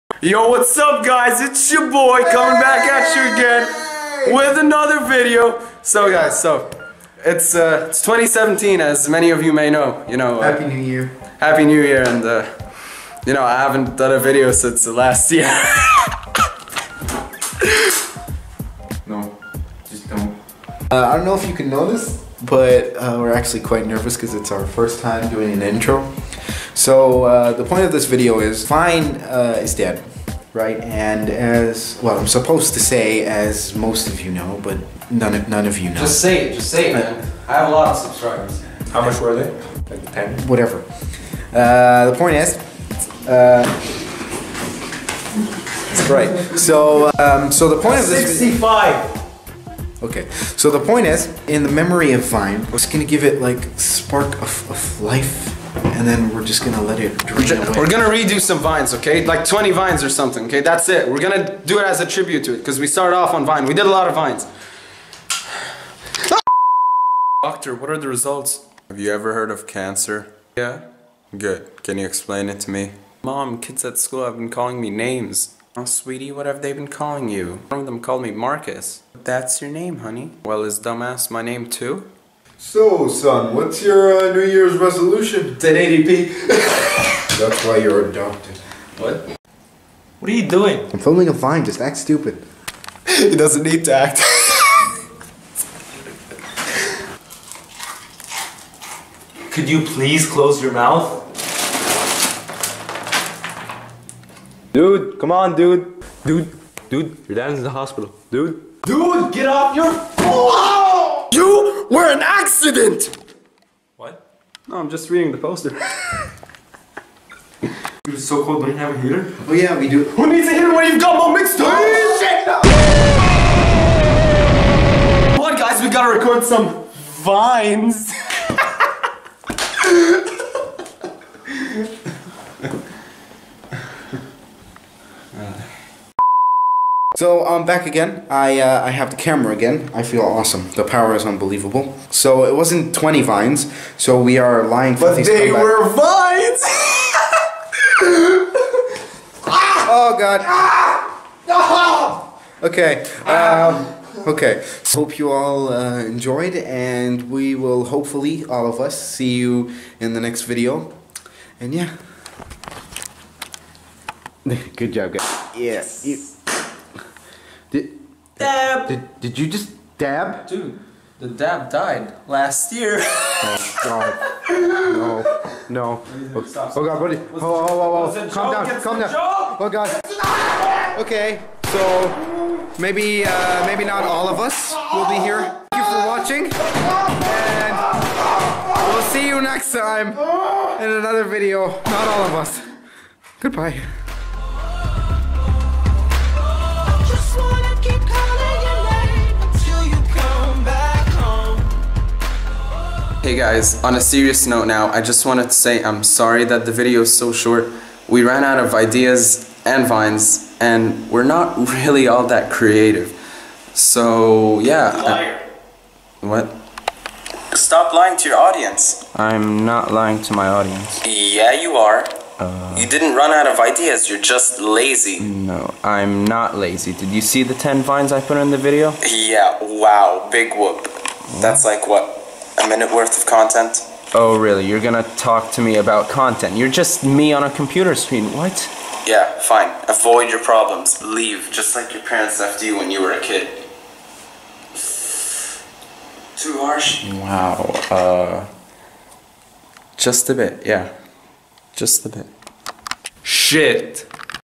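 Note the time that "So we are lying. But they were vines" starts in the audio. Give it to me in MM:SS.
02:23.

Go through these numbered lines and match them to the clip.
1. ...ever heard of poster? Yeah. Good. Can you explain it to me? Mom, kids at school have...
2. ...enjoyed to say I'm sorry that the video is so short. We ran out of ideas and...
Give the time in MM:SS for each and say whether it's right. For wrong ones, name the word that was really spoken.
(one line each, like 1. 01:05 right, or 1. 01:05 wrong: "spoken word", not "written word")
1. 01:09 wrong: "cancer", not "poster"
2. 03:25 wrong: "wanted", not "enjoyed".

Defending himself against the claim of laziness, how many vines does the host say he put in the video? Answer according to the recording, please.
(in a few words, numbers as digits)
10.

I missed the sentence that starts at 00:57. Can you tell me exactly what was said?
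We're gonna redo some vines, okay?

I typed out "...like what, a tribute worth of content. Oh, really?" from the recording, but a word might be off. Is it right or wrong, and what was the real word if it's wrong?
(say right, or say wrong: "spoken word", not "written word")
wrong: "minute", not "tribute".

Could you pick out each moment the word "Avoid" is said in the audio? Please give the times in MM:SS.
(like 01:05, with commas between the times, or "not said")
03:59.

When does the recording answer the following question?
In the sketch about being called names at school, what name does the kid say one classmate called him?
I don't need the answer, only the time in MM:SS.
01:18.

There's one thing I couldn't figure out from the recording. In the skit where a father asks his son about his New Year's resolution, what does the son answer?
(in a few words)
1080p.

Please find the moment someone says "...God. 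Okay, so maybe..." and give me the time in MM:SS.
02:59.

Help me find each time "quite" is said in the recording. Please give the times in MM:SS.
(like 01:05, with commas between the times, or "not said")
00:23.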